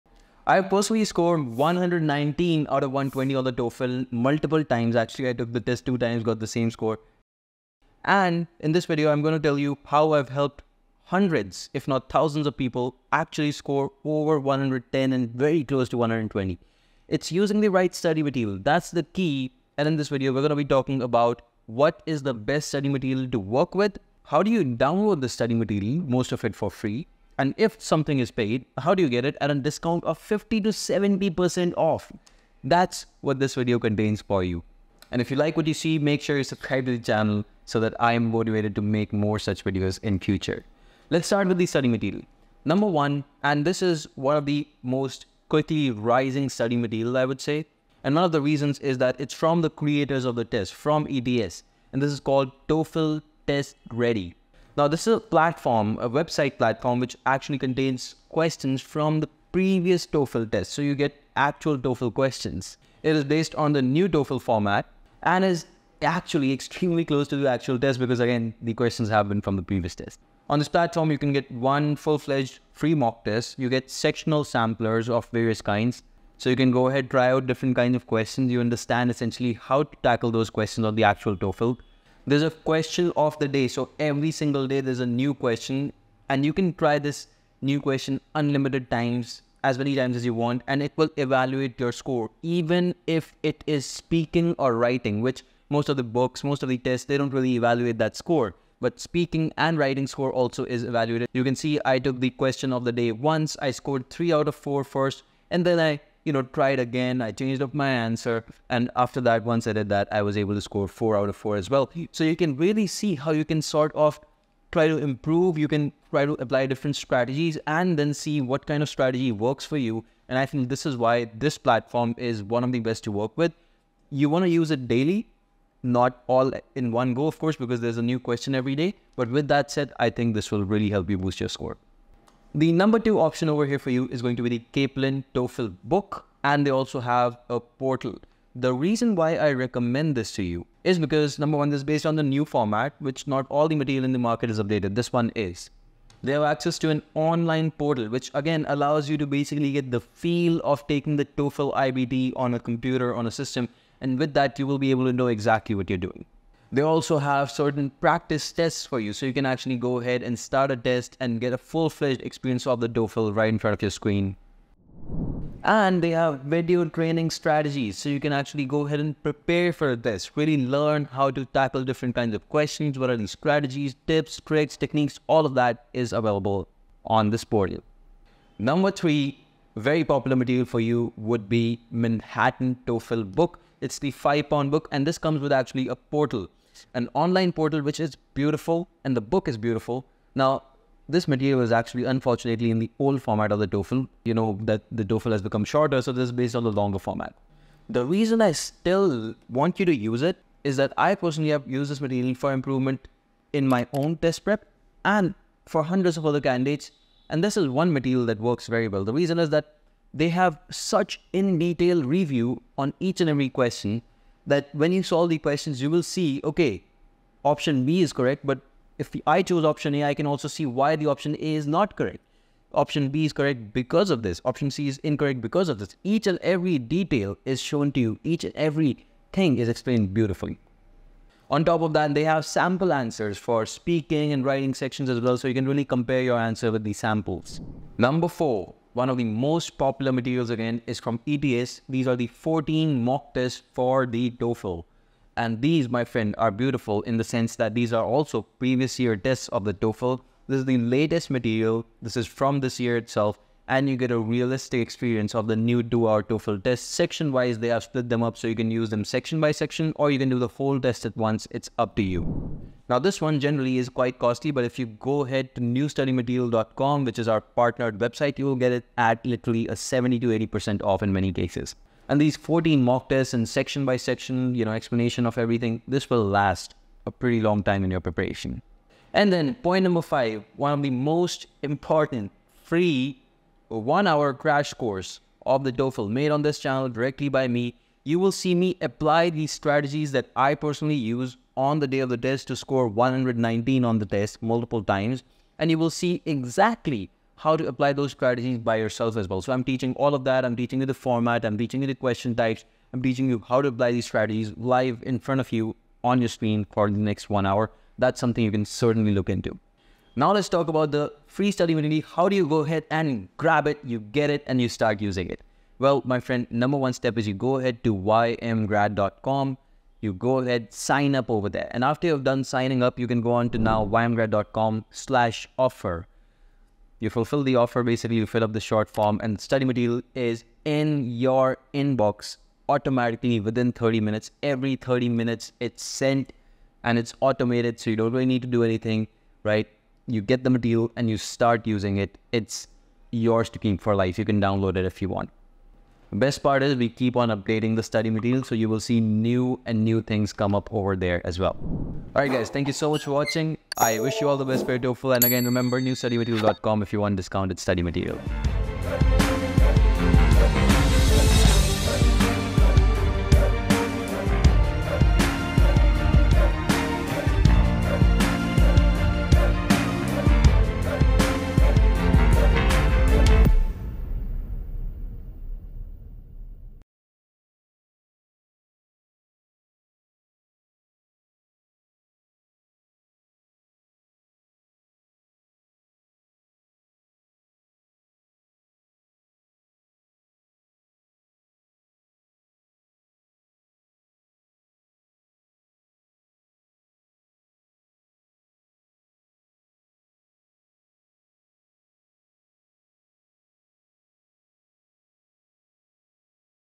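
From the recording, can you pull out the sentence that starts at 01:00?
So you get actual TOEFL questions.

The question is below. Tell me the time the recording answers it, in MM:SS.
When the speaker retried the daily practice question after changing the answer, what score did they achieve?
01:50.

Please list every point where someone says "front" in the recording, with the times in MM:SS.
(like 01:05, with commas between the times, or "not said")
02:43, 05:05.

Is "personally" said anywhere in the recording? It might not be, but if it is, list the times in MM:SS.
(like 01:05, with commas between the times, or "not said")
00:00, 03:21, 04:50.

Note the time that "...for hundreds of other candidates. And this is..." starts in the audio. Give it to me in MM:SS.
03:25.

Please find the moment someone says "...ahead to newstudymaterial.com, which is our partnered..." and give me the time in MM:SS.
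04:25.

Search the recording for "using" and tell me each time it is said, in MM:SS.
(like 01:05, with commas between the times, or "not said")
00:17, 05:14, 05:41.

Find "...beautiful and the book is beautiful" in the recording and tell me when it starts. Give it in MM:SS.
03:08.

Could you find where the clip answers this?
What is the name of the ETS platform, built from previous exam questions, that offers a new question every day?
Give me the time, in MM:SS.
00:52.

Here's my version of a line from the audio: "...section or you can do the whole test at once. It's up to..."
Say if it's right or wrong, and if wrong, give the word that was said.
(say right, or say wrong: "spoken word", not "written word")
right.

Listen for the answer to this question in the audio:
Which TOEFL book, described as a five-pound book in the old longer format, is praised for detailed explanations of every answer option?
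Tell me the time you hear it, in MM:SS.
03:01.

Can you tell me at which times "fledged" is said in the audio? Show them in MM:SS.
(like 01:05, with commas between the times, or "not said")
01:11, 02:41.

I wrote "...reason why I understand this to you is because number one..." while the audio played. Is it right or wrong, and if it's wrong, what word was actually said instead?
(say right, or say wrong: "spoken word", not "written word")
wrong: "recommend", not "understand".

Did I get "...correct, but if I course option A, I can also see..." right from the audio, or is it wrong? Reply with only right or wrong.
wrong.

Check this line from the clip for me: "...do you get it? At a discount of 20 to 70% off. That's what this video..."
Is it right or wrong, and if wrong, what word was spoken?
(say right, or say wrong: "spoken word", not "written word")
wrong: "50", not "20".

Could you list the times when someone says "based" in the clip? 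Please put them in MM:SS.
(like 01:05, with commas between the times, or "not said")
01:03, 02:21, 03:16.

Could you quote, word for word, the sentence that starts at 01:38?
But speaking and writing score also is evaluated.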